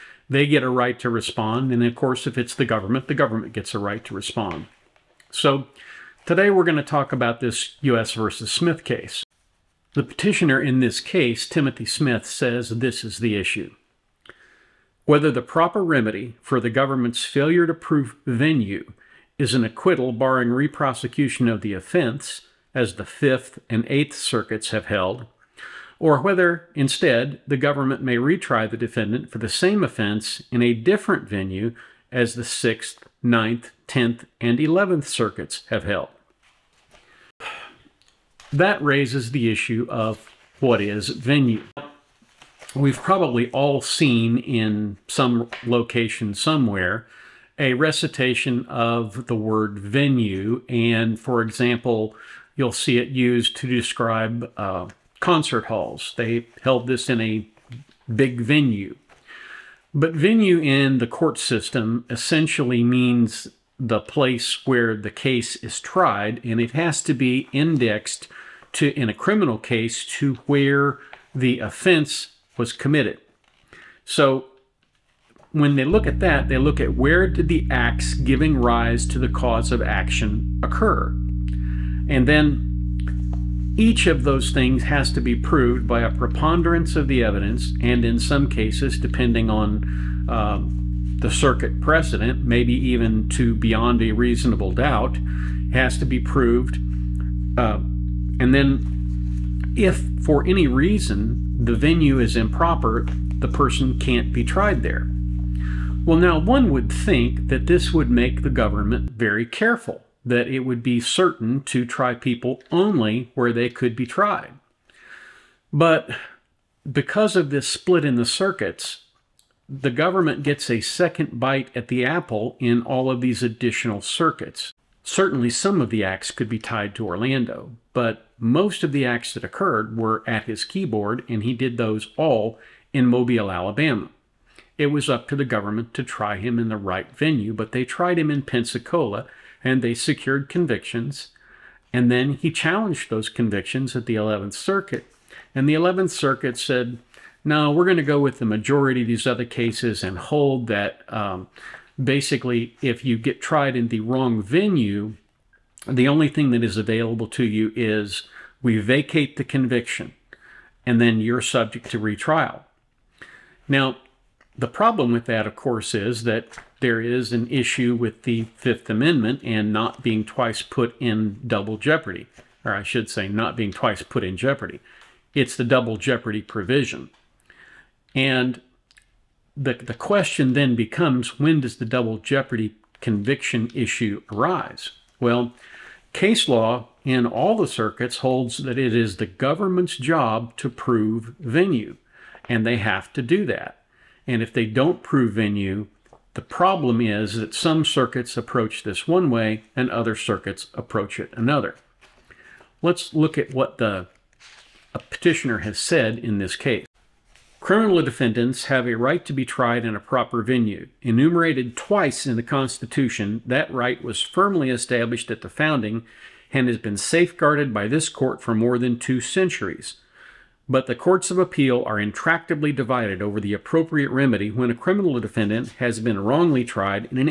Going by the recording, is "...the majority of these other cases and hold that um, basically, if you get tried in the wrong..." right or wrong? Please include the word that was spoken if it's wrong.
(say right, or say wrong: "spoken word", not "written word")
right.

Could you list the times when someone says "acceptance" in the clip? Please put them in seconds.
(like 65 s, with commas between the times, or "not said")
not said.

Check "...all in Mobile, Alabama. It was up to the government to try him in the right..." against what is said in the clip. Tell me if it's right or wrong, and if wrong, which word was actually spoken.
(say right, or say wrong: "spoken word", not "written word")
right.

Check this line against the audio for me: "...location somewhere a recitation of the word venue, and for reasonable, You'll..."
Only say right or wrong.
wrong.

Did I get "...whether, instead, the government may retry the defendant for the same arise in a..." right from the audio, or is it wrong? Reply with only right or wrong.
wrong.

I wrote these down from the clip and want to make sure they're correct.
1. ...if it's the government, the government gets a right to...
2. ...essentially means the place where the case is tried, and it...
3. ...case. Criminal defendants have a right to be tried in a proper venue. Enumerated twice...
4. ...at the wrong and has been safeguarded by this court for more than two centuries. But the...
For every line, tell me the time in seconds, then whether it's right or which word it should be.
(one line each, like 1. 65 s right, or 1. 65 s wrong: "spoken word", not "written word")
1. 2 s right
2. 62 s right
3. 206 s right
4. 215 s wrong: "founding", not "wrong".